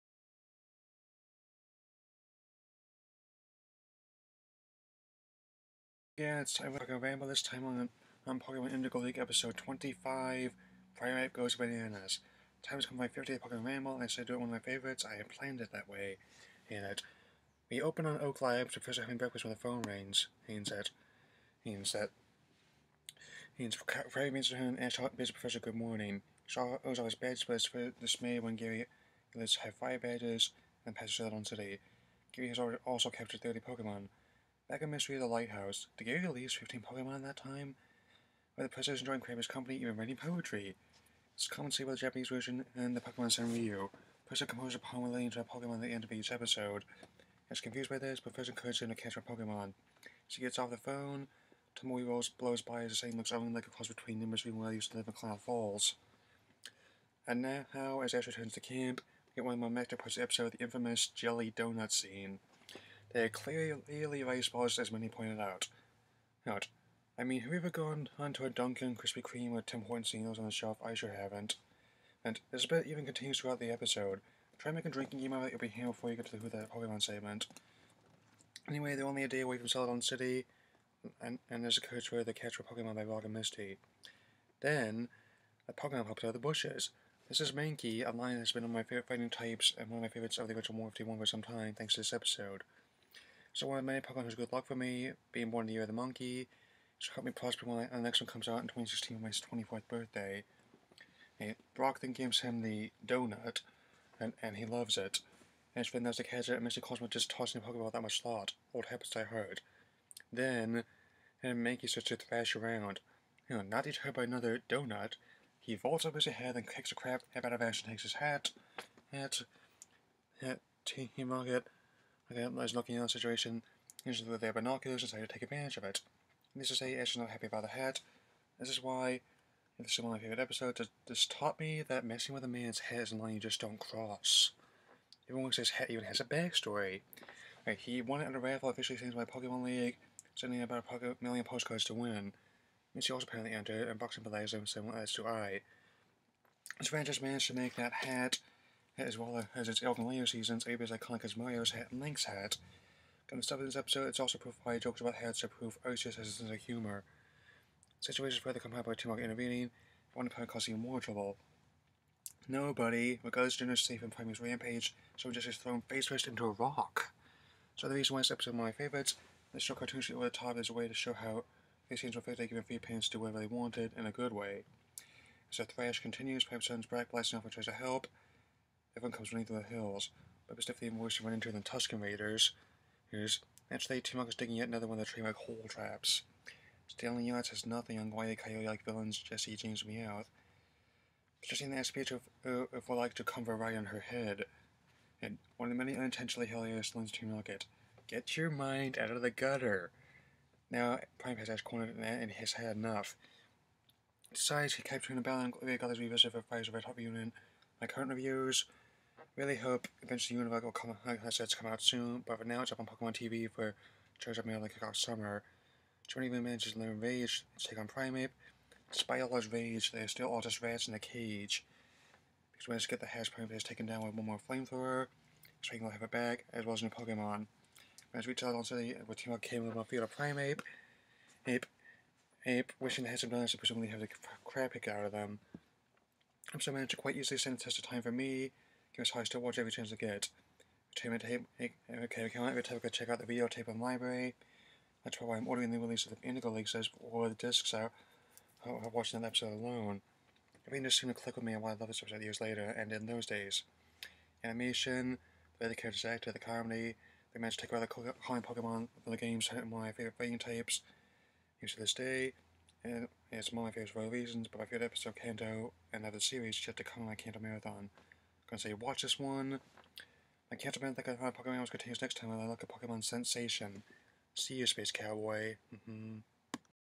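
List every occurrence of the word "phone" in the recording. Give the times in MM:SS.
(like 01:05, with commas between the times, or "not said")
00:19, 00:50.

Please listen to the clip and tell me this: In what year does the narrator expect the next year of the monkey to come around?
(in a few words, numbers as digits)
2016.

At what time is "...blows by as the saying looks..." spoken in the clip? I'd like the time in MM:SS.
00:52.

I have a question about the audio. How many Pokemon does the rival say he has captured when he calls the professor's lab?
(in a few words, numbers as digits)
30.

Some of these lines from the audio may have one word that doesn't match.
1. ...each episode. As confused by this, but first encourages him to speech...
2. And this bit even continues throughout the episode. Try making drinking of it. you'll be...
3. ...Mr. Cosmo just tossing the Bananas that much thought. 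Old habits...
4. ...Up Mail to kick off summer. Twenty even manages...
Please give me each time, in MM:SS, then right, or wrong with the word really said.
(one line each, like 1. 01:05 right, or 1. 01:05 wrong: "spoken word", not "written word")
1. 00:46 wrong: "catch", not "speech"
2. 01:12 right
3. 01:46 wrong: "Pokeball", not "Bananas"
4. 03:34 right.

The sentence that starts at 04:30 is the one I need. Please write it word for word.
I can't remember that I of Pokemon I was gonna use next time.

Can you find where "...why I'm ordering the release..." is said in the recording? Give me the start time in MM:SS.
04:05.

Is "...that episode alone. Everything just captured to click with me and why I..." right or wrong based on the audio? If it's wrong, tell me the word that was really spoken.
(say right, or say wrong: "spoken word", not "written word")
wrong: "seemed", not "captured".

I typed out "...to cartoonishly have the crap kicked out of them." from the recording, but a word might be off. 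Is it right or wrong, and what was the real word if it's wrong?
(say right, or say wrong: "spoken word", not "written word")
wrong: "presumably", not "cartoonishly".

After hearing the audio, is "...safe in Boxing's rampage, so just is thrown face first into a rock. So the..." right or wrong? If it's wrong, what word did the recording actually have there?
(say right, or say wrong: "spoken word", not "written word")
wrong: "Prime", not "Boxing".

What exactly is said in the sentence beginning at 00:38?
Where the is enjoying Kramer's company even writing poetry?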